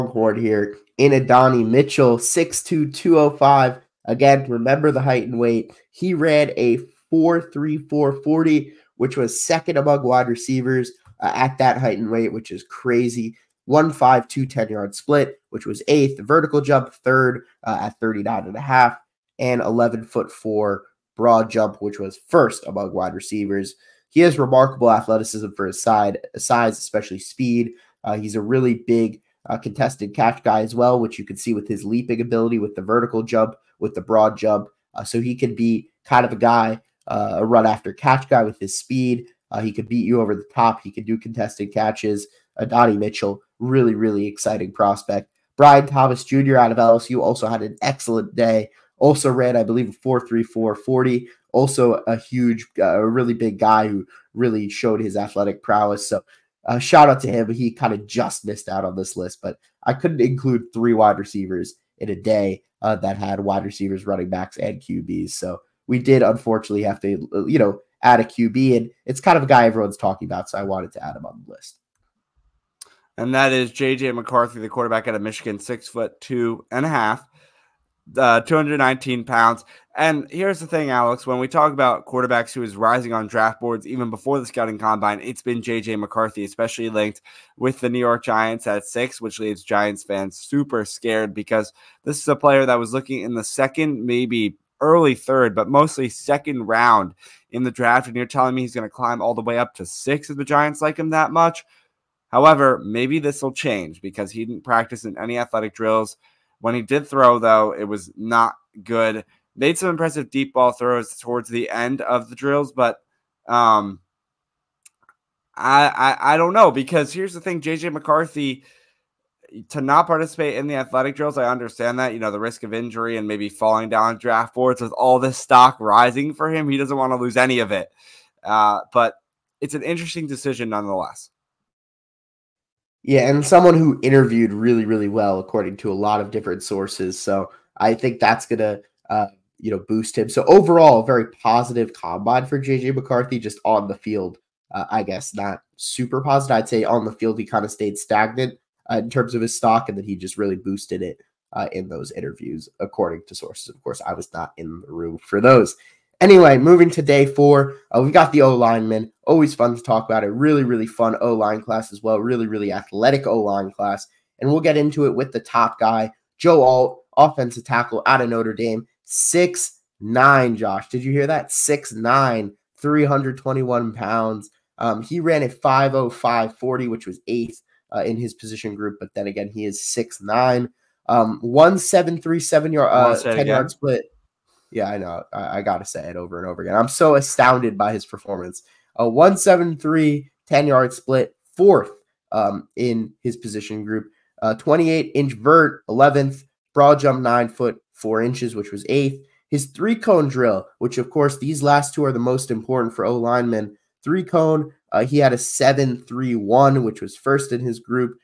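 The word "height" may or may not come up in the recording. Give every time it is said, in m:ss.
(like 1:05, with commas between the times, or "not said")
0:04, 0:11.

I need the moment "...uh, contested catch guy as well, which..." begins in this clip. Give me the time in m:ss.
0:29.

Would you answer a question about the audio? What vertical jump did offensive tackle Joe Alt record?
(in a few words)
28 inches.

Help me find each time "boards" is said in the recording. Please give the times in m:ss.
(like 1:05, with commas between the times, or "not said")
1:23, 2:04.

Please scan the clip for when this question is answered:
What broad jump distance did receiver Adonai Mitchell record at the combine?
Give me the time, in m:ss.
0:19.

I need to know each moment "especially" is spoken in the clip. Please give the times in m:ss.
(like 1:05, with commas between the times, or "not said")
0:26, 1:26.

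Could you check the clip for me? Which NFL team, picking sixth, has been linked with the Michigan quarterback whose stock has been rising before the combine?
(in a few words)
New York Giants.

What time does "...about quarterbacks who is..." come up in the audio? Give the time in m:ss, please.
1:21.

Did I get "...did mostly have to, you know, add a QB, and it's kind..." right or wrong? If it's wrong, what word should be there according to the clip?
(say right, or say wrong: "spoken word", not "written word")
wrong: "unfortunately", not "mostly".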